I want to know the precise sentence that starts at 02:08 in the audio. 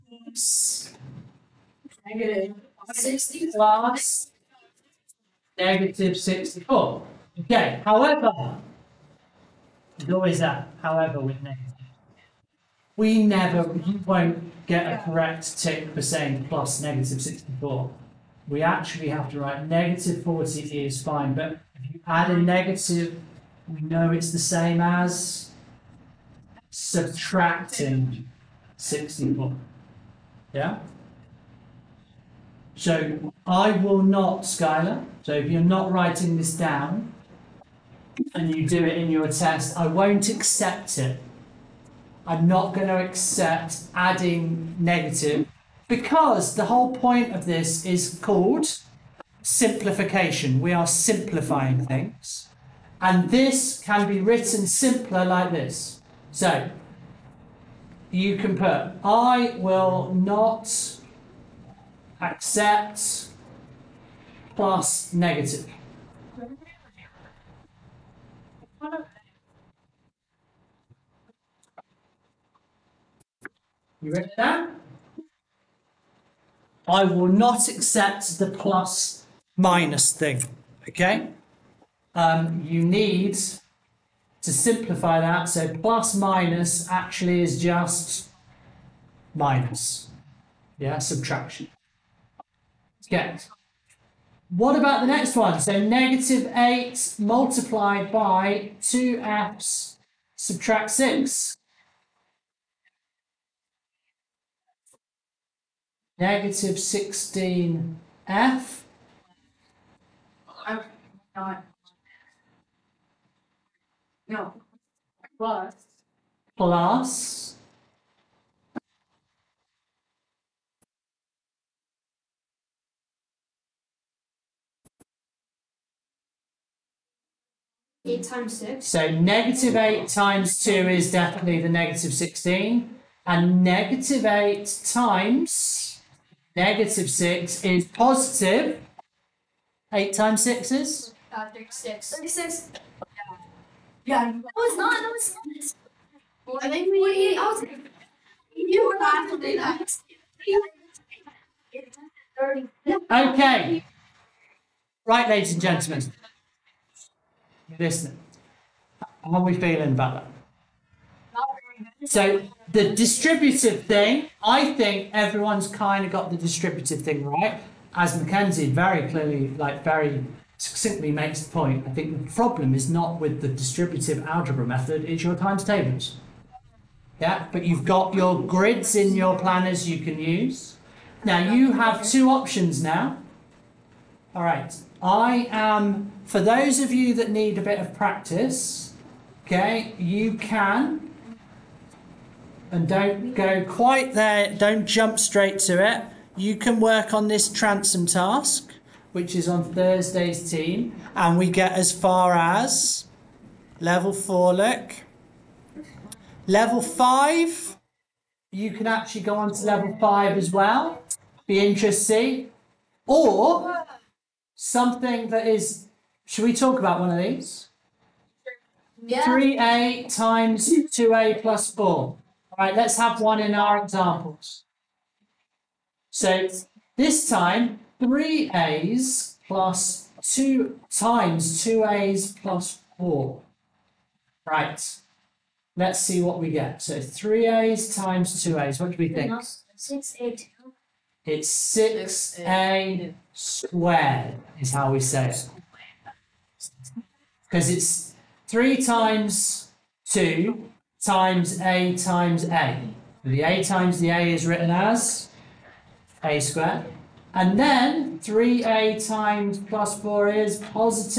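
So negative eight times two is definitely the negative 16.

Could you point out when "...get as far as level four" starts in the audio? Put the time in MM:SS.
03:21.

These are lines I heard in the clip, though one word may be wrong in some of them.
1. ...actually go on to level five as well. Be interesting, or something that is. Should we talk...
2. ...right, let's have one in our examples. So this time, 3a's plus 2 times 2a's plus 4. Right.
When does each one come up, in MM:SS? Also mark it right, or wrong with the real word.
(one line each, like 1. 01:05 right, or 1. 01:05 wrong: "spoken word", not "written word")
1. 03:28 right
2. 03:42 right.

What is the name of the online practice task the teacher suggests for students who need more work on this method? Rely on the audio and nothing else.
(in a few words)
Transum.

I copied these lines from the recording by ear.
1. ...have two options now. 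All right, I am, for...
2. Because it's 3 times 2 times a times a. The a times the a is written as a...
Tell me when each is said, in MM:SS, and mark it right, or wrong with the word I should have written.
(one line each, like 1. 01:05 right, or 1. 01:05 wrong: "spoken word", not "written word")
1. 03:01 right
2. 04:07 right.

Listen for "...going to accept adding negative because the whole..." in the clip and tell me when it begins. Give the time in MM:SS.
00:42.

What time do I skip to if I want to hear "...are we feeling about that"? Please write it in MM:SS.
02:39.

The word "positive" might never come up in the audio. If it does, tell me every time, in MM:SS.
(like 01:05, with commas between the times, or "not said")
02:17, 04:20.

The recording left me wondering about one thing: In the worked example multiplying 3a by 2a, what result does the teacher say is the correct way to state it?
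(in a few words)
6a squared.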